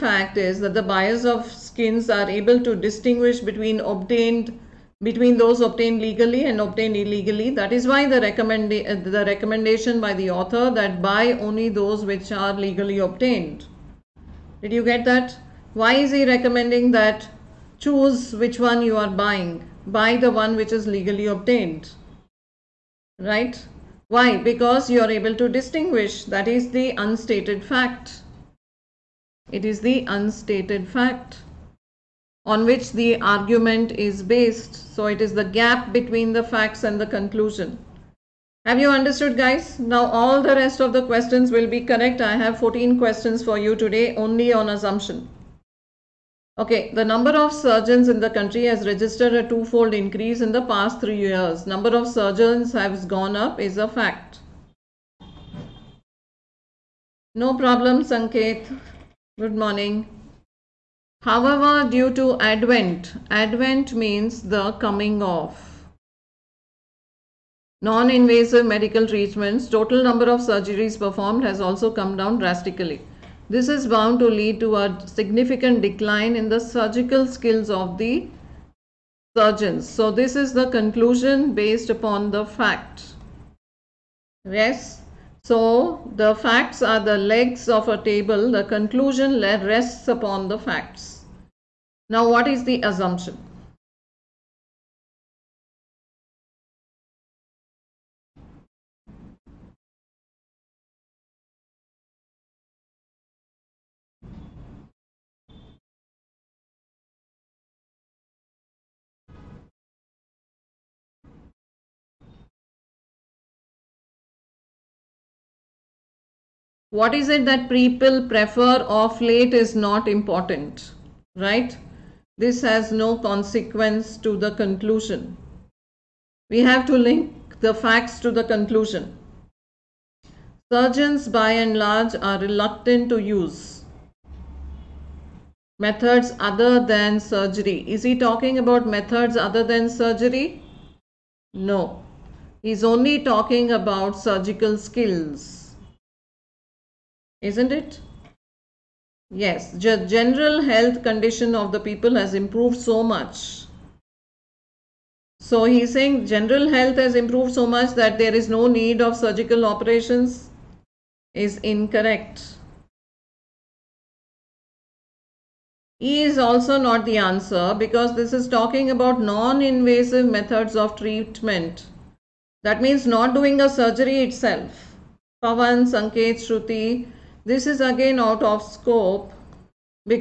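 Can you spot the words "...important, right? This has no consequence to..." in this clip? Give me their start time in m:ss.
2:00.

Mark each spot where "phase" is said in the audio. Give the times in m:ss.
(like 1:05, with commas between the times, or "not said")
not said.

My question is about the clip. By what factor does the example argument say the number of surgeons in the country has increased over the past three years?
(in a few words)
Twofold.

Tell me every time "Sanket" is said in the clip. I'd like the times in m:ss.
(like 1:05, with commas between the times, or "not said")
0:58, 2:55.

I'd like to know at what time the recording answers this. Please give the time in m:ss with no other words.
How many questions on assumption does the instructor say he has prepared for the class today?
0:42.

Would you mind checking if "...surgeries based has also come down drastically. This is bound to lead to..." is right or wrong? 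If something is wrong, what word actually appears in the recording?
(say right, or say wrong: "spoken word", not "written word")
wrong: "performed", not "based".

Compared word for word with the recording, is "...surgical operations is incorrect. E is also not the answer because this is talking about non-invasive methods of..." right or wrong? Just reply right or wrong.
right.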